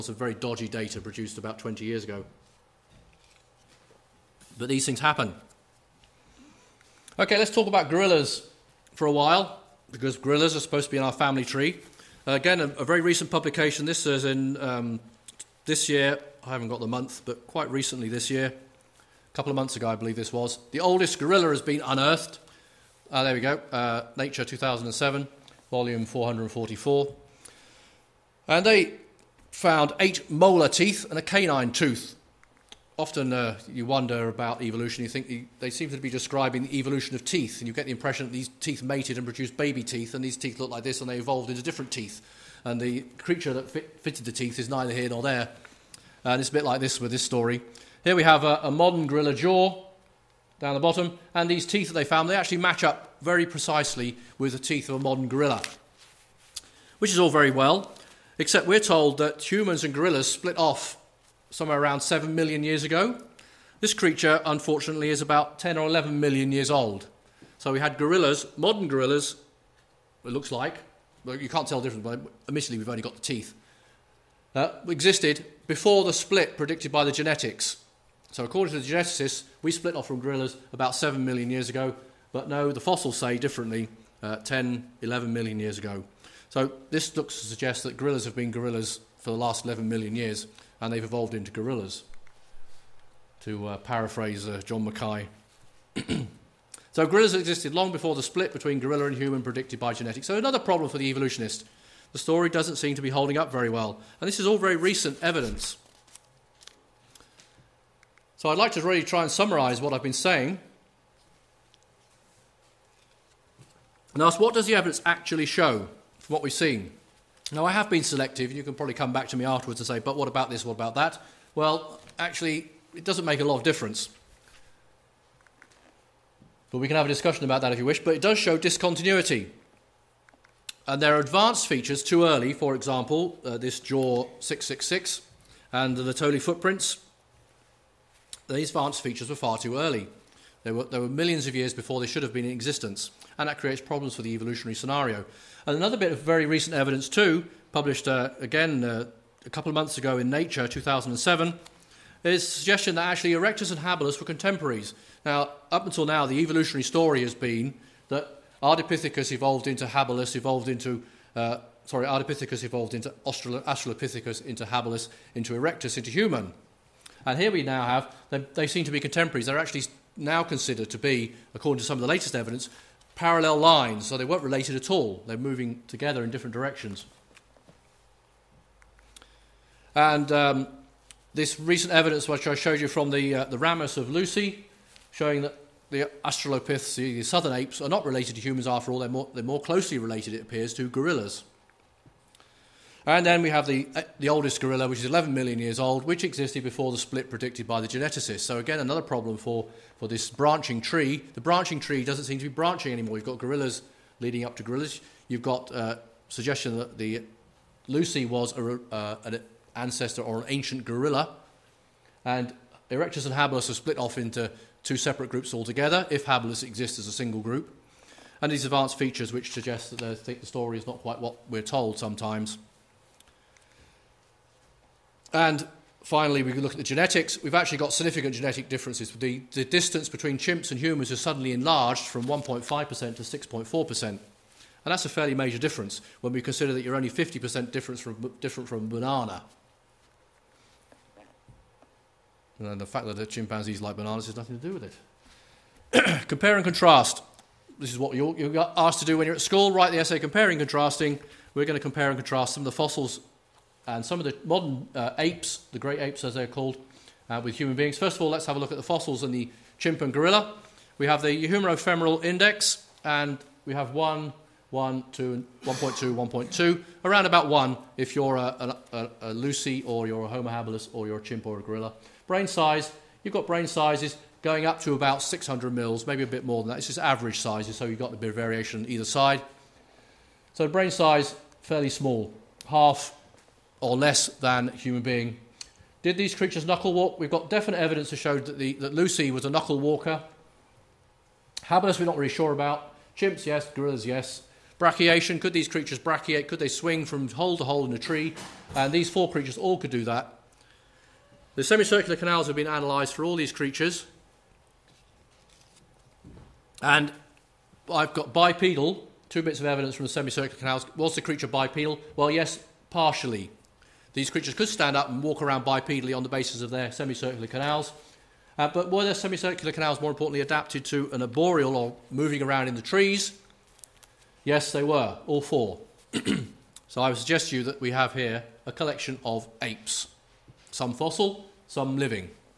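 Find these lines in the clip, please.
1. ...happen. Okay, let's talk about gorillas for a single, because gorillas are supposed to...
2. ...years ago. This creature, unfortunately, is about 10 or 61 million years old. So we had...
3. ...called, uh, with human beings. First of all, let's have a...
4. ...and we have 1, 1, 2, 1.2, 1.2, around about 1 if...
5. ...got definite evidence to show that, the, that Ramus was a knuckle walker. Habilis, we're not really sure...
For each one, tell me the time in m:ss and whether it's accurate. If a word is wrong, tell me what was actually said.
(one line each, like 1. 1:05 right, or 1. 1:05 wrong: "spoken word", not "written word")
1. 0:05 wrong: "while", not "single"
2. 1:02 wrong: "11", not "61"
3. 4:16 right
4. 4:23 right
5. 4:47 wrong: "Lucy", not "Ramus".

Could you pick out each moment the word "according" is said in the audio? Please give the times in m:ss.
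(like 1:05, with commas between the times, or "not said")
1:18, 2:51.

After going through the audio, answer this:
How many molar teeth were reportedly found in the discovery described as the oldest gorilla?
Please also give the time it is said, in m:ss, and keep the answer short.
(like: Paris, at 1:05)
8, at 0:30.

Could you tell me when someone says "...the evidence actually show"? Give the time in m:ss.
1:54.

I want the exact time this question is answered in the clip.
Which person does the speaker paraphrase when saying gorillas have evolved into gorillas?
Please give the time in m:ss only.
1:34.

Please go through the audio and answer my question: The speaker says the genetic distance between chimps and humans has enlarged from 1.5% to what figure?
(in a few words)
6.4%.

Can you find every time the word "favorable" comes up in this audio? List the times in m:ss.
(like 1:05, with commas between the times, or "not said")
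not said.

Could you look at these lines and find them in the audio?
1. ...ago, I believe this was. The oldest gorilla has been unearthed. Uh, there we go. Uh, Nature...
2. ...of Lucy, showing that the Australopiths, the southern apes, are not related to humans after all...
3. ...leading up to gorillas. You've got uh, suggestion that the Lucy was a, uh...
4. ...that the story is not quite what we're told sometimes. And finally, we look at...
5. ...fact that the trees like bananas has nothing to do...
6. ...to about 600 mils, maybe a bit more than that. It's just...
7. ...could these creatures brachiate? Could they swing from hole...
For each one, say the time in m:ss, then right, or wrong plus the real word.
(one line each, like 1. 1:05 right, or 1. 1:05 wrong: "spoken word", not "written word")
1. 0:19 right
2. 3:03 right
3. 3:24 right
4. 3:39 right
5. 4:02 wrong: "chimpanzees", not "trees"
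6. 4:34 right
7. 4:55 right.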